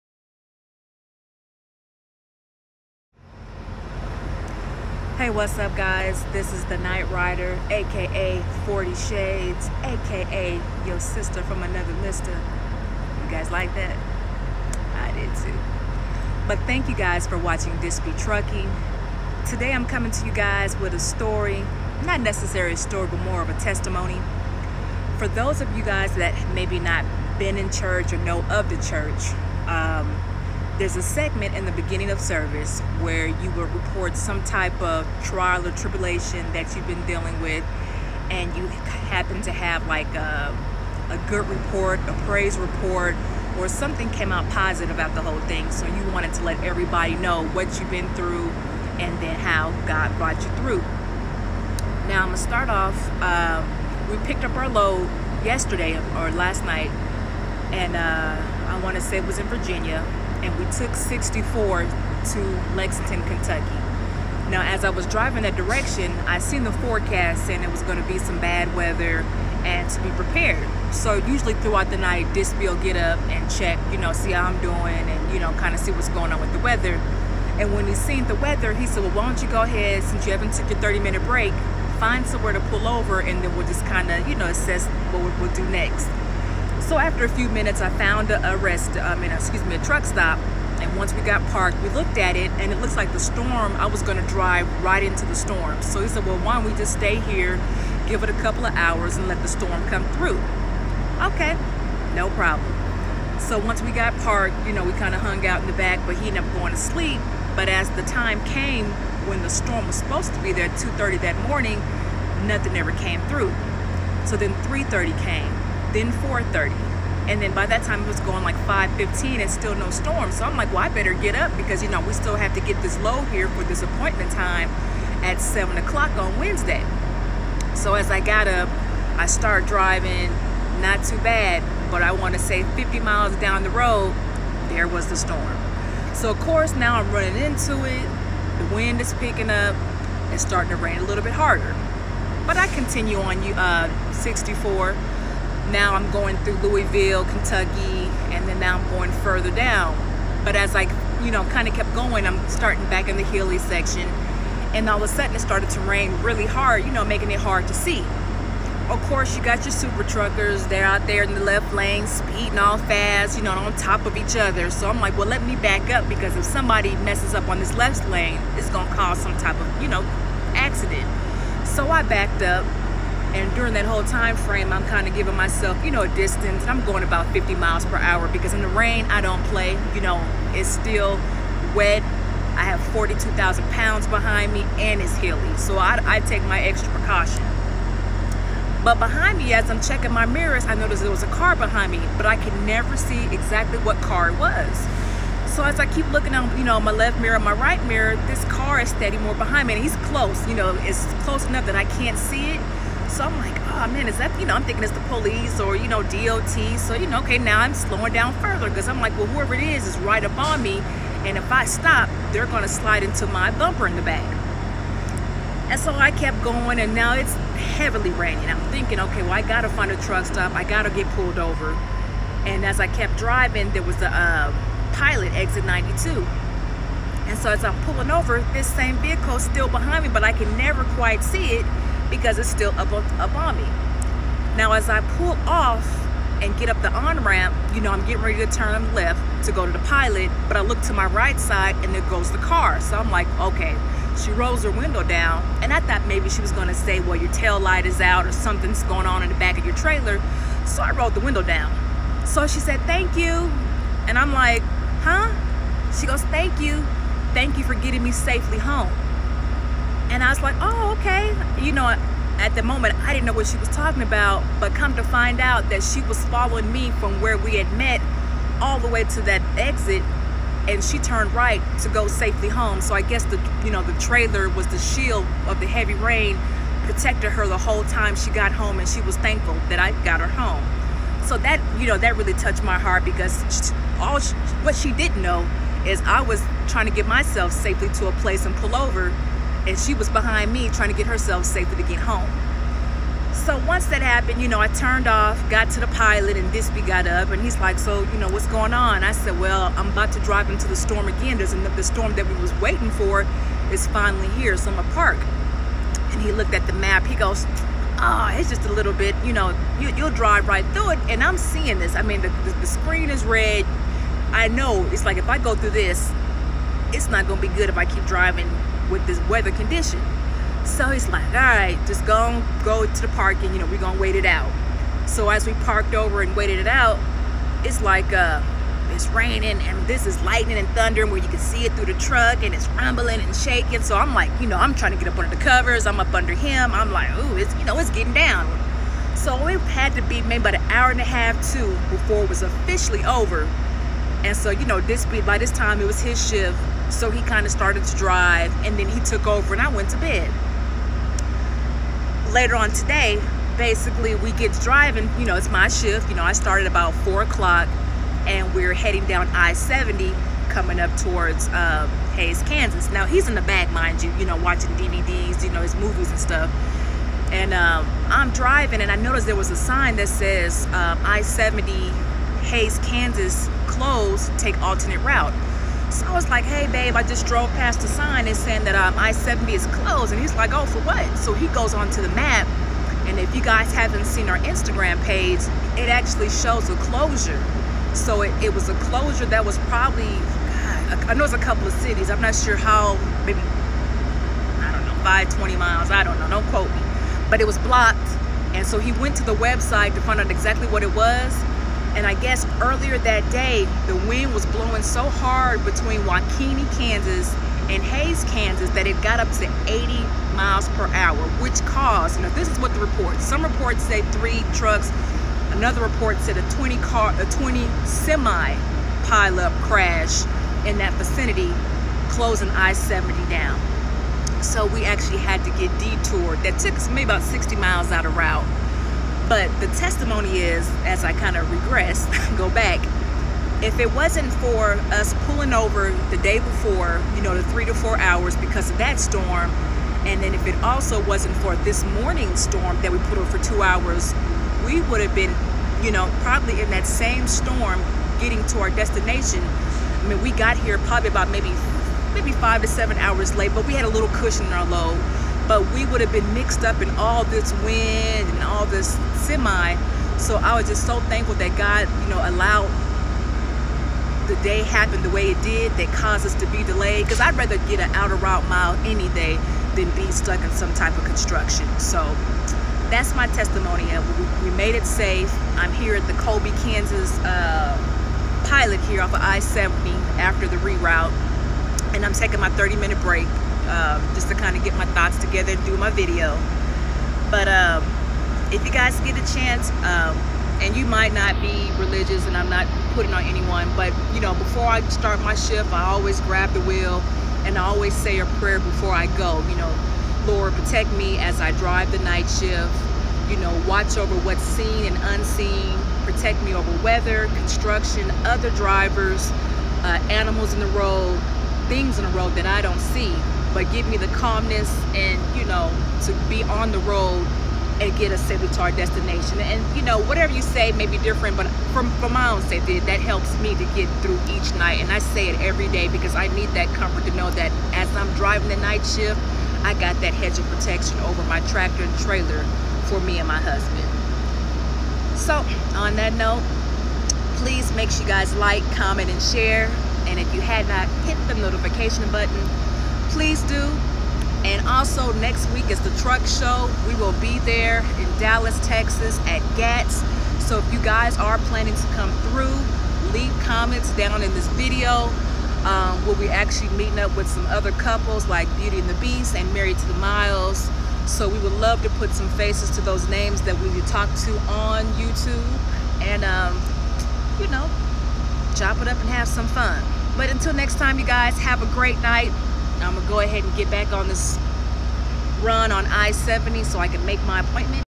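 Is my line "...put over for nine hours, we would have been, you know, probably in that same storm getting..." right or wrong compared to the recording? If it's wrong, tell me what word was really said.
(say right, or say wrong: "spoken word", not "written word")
wrong: "two", not "nine".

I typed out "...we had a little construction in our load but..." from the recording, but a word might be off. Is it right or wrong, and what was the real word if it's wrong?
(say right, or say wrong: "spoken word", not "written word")
wrong: "cushion", not "construction".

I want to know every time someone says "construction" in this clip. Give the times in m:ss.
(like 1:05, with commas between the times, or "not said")
7:51, 8:27.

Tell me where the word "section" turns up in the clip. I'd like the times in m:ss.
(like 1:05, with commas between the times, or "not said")
2:33.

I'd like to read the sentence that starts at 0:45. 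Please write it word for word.
So you wanted to let everybody know what you've been through and then how God brought you through.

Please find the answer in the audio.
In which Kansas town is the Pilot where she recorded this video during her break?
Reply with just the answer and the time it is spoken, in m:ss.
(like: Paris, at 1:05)
Colby, at 7:56.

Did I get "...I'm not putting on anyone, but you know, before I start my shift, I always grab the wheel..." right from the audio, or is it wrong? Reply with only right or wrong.
right.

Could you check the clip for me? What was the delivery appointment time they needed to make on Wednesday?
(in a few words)
7 o'clock.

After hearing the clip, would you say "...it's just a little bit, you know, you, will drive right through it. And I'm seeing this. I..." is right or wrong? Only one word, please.
right.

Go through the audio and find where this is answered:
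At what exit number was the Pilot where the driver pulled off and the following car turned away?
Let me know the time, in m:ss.
3:45.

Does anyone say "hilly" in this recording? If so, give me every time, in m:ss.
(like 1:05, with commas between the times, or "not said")
2:33, 3:05.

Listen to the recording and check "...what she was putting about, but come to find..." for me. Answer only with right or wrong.
wrong.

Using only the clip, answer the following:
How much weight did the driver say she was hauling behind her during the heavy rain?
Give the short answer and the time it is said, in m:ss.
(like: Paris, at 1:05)
42,000 pounds, at 3:02.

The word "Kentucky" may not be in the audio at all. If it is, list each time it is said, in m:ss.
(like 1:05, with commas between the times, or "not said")
1:03, 2:27.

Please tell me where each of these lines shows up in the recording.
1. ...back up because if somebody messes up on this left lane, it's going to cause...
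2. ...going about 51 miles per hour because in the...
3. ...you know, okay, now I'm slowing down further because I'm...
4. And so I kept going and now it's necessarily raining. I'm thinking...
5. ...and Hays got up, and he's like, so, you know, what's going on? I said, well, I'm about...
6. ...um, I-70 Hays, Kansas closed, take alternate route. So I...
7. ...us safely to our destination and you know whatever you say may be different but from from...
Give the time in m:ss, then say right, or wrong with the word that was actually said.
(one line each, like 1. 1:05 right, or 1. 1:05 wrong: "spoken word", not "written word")
1. 2:45 right
2. 2:56 wrong: "50", not "51"
3. 3:26 right
4. 3:35 wrong: "heavily", not "necessarily"
5. 4:56 wrong: "Disby", not "Hays"
6. 6:10 right
7. 8:38 right.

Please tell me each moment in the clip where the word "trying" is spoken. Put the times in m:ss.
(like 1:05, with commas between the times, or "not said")
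4:46, 4:50, 5:34.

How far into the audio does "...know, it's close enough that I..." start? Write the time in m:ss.
3:20.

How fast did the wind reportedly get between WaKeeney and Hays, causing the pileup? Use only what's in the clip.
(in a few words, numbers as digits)
80 miles per hour.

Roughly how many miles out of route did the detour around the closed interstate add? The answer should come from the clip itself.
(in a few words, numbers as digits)
60 miles.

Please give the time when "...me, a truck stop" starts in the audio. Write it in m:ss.
1:29.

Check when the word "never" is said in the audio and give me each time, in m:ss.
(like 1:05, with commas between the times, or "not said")
3:12, 3:50.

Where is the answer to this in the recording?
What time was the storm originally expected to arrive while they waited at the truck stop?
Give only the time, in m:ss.
1:50.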